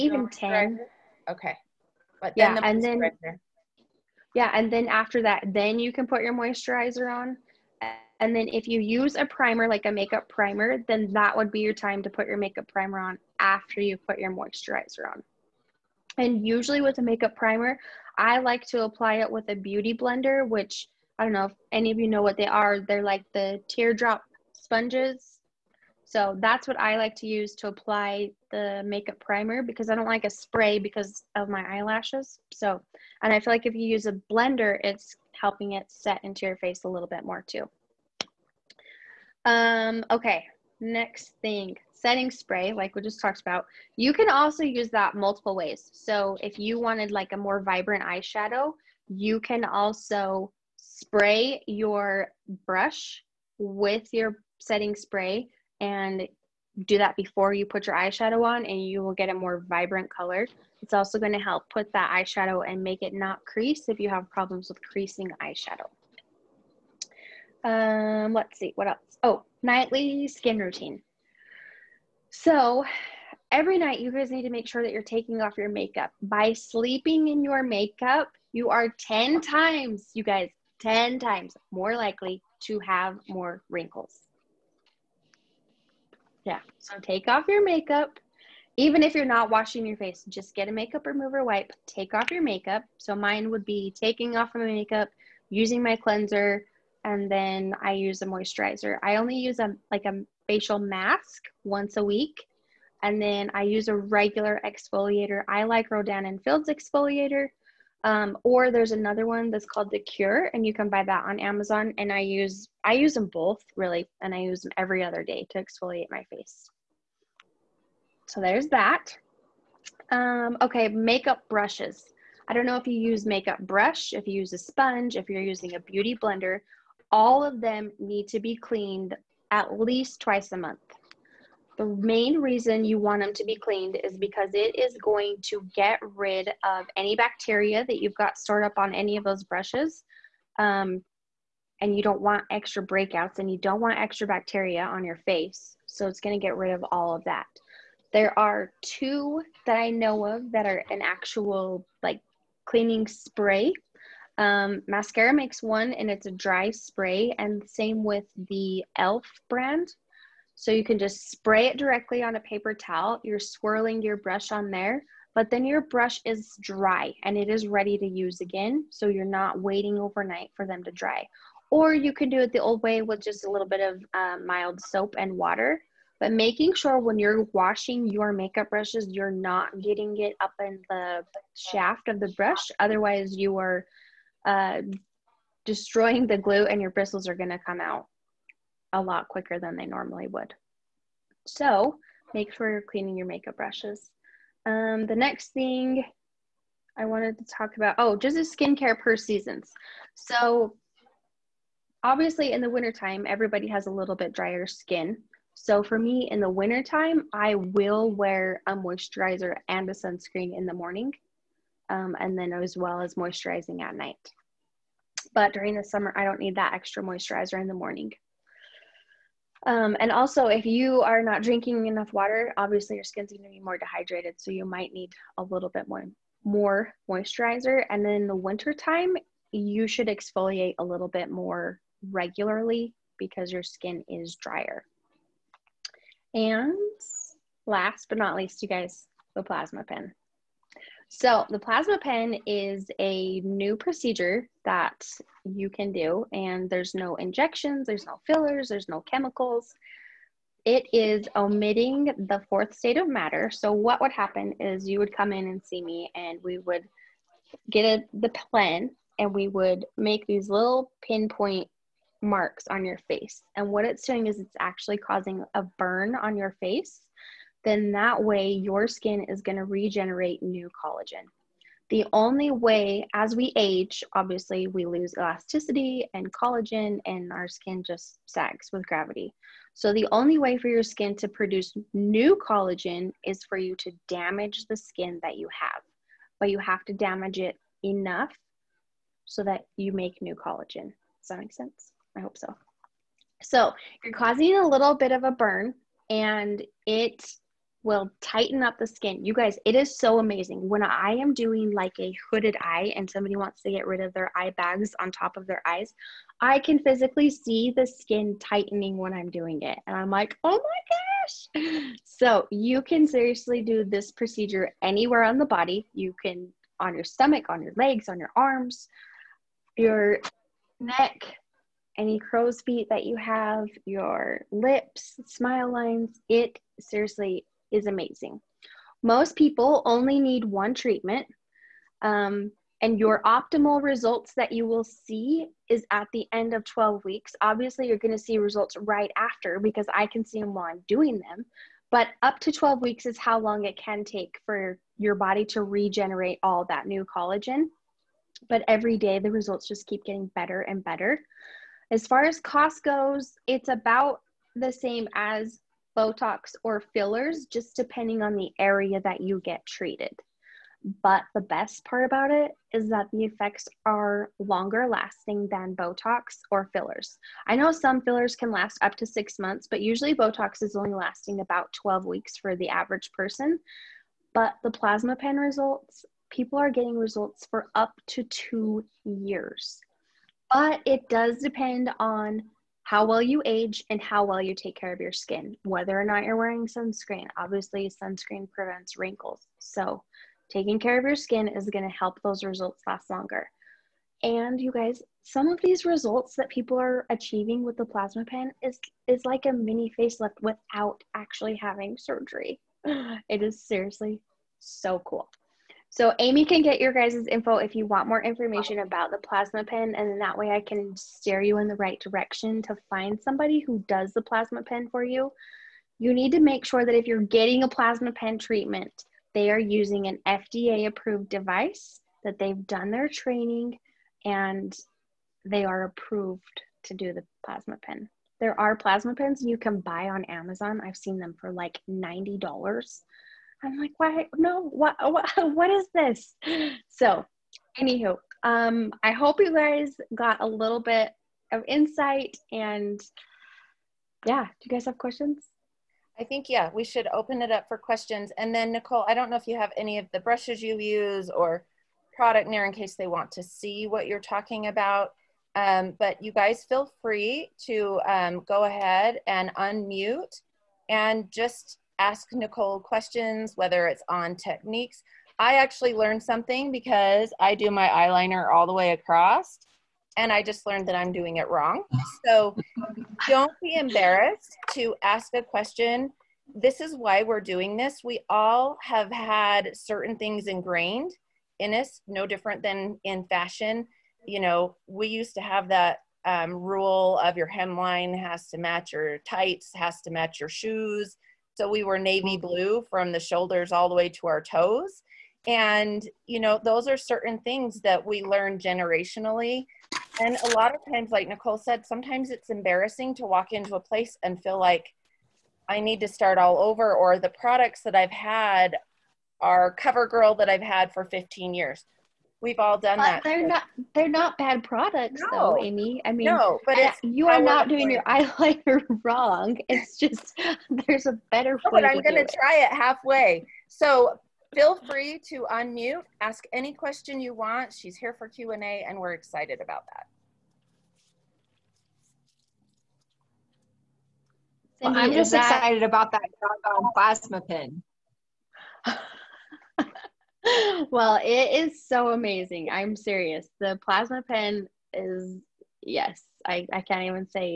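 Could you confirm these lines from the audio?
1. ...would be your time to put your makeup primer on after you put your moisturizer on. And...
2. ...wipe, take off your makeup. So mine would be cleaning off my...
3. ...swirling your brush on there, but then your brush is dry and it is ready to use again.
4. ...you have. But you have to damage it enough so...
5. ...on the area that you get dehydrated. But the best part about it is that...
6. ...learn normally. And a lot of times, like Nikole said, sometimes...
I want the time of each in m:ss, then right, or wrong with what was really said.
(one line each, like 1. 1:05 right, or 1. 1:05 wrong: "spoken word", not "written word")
1. 0:11 right
2. 1:31 wrong: "taking", not "cleaning"
3. 2:43 right
4. 4:45 right
5. 5:58 wrong: "treated", not "dehydrated"
6. 8:18 wrong: "generationally", not "normally".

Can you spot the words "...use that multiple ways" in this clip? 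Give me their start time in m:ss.
0:44.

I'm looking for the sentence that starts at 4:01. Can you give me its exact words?
So, the plasma pen is a new procedure that you can do, and there's no injections, there's no fillers, there's no chemicals.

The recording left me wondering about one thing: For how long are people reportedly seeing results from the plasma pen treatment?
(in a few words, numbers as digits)
2 years.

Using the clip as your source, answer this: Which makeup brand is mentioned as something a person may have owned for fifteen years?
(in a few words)
CoverGirl.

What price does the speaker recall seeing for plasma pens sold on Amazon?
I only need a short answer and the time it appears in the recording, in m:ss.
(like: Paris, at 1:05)
$90, at 7:11.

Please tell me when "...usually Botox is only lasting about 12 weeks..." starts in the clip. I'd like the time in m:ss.
6:09.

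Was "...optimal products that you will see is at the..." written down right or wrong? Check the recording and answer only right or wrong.
wrong.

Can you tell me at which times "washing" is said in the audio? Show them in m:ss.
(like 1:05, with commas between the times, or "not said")
1:29, 2:57.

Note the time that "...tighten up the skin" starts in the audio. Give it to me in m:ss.
4:58.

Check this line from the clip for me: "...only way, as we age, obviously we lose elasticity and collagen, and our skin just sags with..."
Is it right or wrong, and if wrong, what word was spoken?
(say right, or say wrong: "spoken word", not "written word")
right.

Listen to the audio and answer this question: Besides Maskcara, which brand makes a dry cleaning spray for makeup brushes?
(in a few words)
e.l.f.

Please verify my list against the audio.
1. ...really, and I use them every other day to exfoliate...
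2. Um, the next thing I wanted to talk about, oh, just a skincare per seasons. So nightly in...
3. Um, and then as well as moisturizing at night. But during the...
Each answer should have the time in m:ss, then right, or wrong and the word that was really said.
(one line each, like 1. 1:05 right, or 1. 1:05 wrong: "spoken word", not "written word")
1. 1:53 right
2. 3:14 wrong: "obviously", not "nightly"
3. 3:31 right.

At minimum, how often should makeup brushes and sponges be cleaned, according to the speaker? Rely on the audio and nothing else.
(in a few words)
twice a month.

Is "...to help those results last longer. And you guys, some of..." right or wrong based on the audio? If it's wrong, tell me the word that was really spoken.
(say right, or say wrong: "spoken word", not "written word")
right.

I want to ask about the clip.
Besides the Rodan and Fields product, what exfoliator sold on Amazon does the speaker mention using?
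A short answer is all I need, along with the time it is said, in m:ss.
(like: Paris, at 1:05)
The Cure, at 1:49.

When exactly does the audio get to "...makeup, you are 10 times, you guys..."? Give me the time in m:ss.
1:17.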